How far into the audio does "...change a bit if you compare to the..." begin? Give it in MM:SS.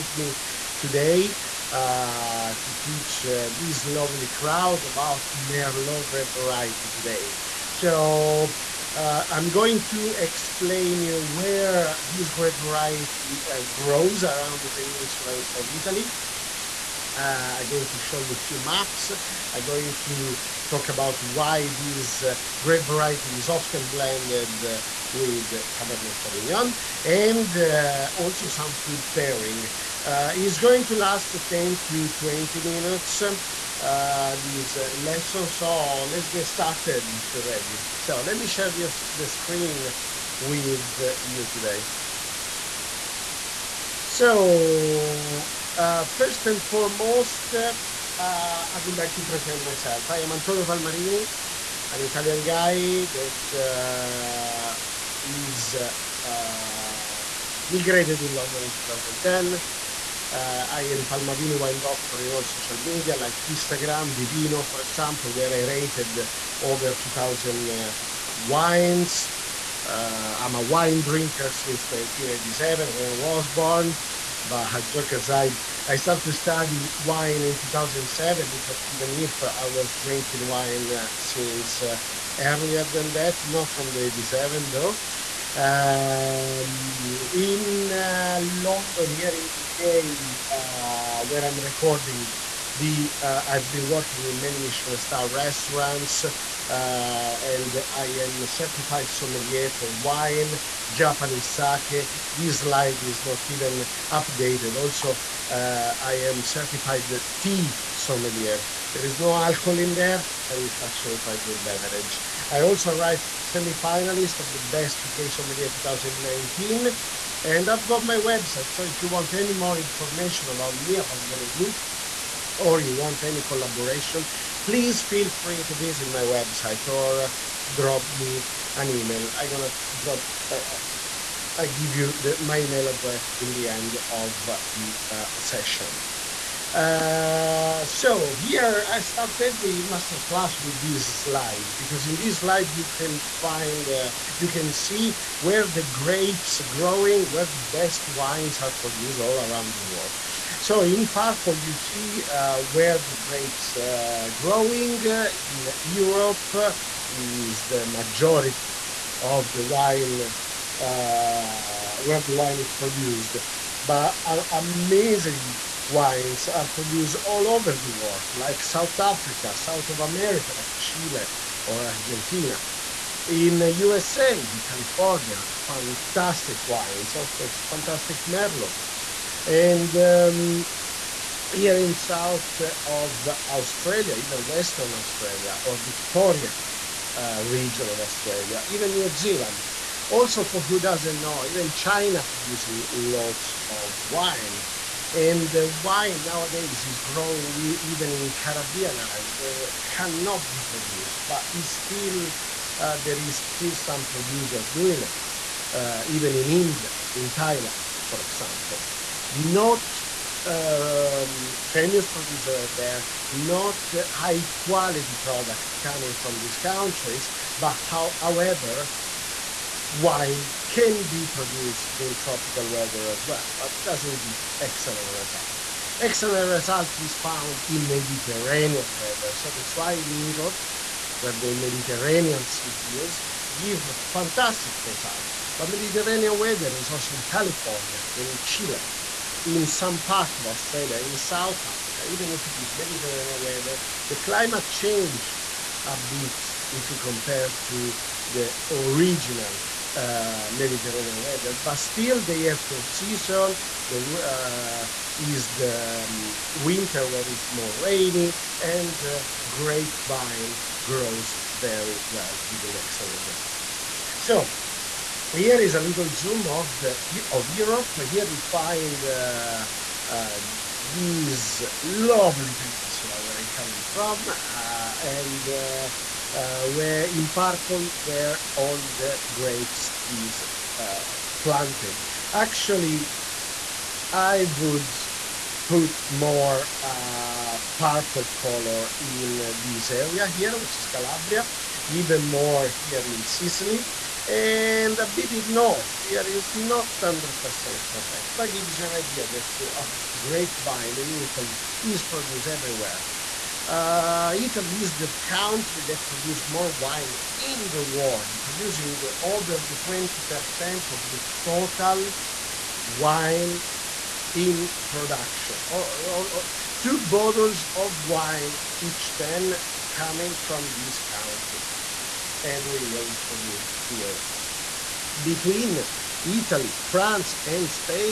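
04:04.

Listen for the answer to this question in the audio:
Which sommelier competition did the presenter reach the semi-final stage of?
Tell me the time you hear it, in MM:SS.
01:54.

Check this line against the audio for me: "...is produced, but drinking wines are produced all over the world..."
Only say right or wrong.
wrong.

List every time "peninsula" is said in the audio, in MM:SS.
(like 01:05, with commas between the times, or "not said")
00:14, 04:32.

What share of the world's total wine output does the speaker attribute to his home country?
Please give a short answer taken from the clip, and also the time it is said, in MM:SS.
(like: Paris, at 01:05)
over 20%, at 05:09.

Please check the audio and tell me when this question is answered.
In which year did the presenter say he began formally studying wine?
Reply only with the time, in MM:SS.
01:17.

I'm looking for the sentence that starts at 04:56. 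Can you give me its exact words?
Here is not 100% correct, but gives you an idea that a grapevine in Italy is produced everywhere.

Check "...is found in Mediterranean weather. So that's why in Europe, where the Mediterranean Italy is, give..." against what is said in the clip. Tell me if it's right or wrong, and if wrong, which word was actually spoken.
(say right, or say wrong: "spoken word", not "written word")
wrong: "Sea", not "Italy".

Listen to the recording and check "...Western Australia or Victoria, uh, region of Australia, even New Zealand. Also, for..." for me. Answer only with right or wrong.
right.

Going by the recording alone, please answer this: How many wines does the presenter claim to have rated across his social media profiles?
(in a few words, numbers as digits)
over 2000.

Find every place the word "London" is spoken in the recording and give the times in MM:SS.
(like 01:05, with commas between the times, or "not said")
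00:58, 01:28.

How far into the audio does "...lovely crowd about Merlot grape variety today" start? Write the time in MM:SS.
00:03.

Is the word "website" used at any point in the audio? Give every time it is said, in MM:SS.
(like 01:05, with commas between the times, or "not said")
01:58, 02:06.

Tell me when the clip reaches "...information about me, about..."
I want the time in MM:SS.
01:59.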